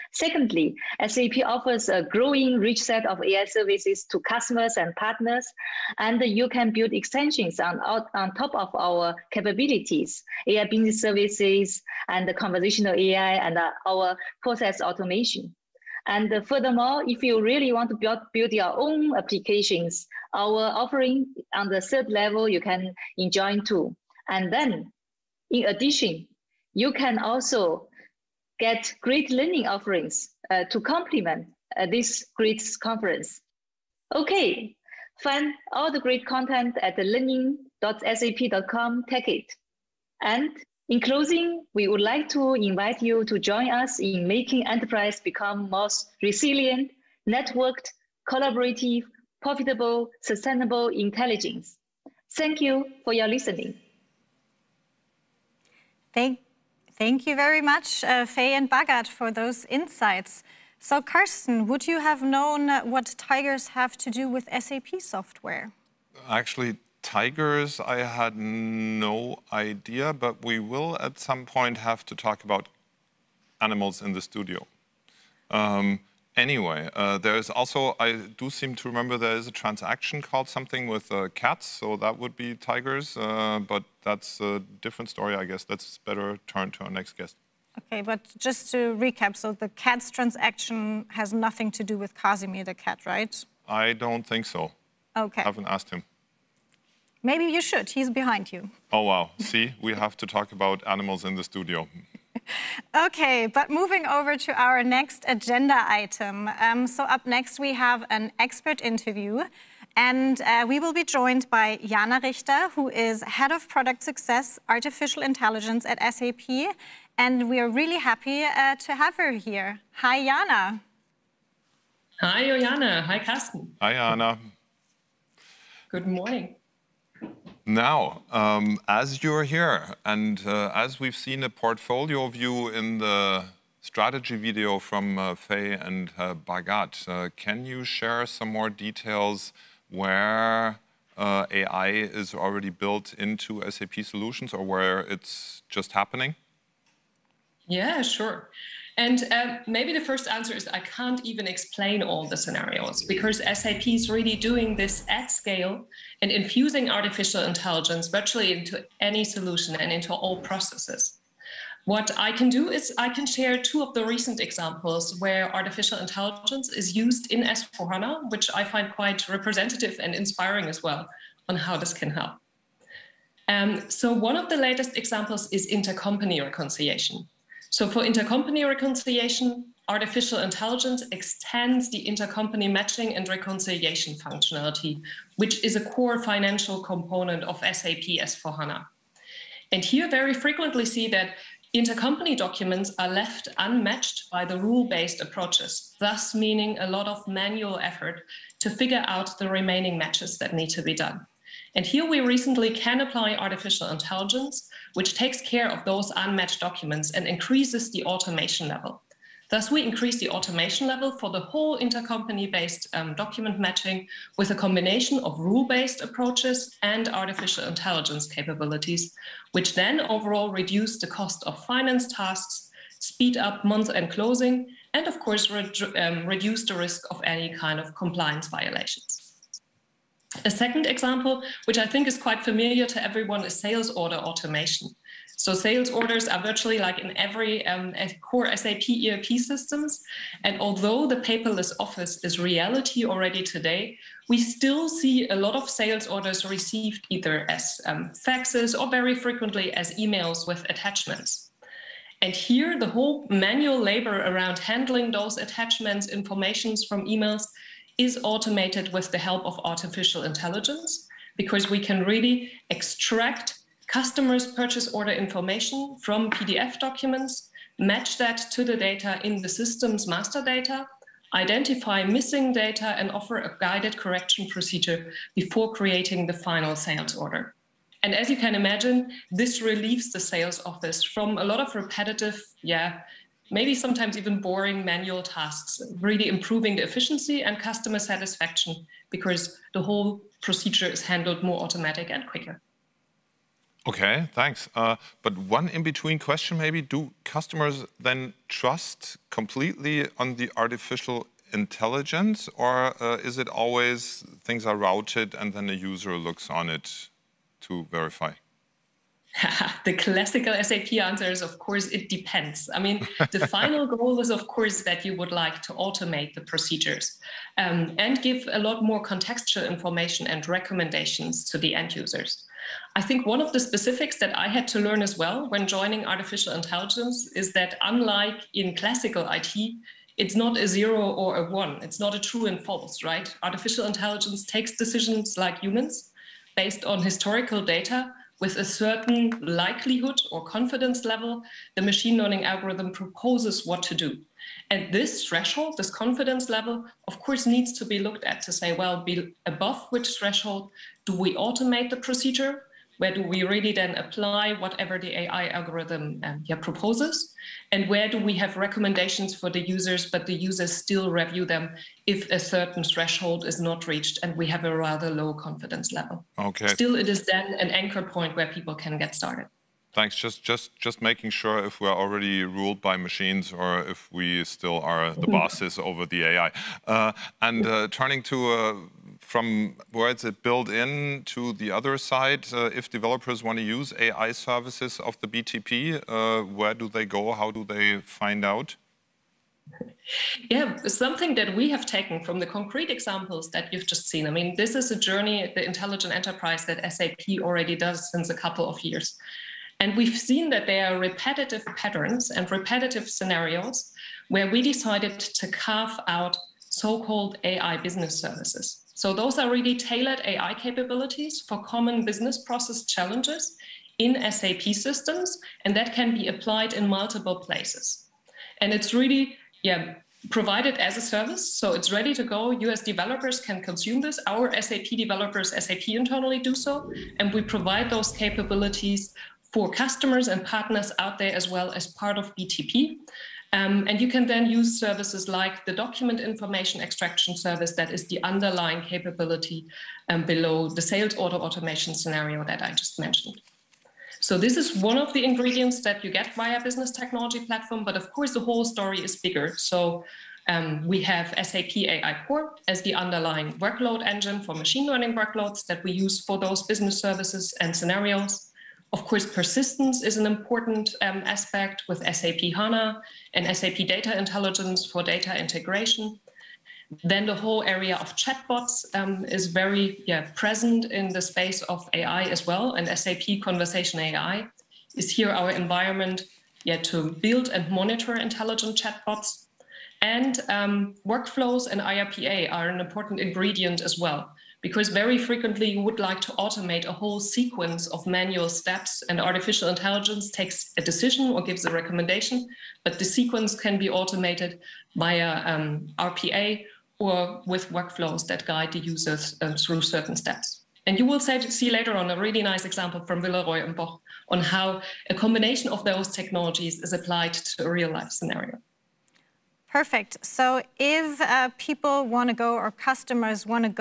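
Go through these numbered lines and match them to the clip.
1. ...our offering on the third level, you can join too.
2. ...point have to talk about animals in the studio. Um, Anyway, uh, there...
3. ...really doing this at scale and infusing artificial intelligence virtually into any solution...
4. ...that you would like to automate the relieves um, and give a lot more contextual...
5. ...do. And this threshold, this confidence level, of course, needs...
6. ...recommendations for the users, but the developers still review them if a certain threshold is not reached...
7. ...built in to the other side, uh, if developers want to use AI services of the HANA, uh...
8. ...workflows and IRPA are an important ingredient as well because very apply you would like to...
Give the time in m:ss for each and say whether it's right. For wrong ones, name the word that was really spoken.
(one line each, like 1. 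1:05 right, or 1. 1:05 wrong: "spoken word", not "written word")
1. 0:20 right
2. 1:11 right
3. 2:34 right
4. 5:14 wrong: "procedures", not "relieves"
5. 5:43 right
6. 5:58 wrong: "users", not "developers"
7. 6:20 wrong: "BTP", not "HANA"
8. 8:01 wrong: "frequently", not "apply".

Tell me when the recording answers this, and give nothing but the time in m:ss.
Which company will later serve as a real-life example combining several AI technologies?
8:23.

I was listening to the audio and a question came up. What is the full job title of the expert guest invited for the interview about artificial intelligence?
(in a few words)
Head of Product Success Artificial Intelligence.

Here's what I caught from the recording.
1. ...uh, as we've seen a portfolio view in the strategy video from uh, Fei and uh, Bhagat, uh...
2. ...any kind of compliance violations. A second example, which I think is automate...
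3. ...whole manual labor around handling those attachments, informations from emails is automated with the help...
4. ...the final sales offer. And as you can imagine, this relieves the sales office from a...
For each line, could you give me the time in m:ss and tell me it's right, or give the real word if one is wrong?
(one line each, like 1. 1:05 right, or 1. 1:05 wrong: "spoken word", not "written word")
1. 2:10 right
2. 3:47 wrong: "quite", not "automate"
3. 4:12 right
4. 4:36 wrong: "order", not "offer".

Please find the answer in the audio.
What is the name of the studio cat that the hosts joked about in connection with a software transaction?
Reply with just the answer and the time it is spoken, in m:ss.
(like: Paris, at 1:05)
Casimir, at 1:32.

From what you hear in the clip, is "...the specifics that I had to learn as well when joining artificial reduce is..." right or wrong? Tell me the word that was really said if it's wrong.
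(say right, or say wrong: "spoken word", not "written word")
wrong: "intelligence", not "reduce".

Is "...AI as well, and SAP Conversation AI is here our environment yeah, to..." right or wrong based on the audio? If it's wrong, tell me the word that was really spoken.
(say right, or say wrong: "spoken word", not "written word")
right.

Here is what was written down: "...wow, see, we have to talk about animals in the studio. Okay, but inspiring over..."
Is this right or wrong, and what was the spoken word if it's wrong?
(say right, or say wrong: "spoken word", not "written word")
wrong: "moving", not "inspiring".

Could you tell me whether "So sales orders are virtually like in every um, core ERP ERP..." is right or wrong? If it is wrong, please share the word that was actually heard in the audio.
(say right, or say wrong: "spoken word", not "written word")
wrong: "SAP", not "ERP".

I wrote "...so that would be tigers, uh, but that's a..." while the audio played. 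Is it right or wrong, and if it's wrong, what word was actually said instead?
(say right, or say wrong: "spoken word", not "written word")
right.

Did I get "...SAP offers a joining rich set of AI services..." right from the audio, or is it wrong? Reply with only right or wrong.
wrong.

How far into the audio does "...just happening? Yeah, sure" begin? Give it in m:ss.
2:25.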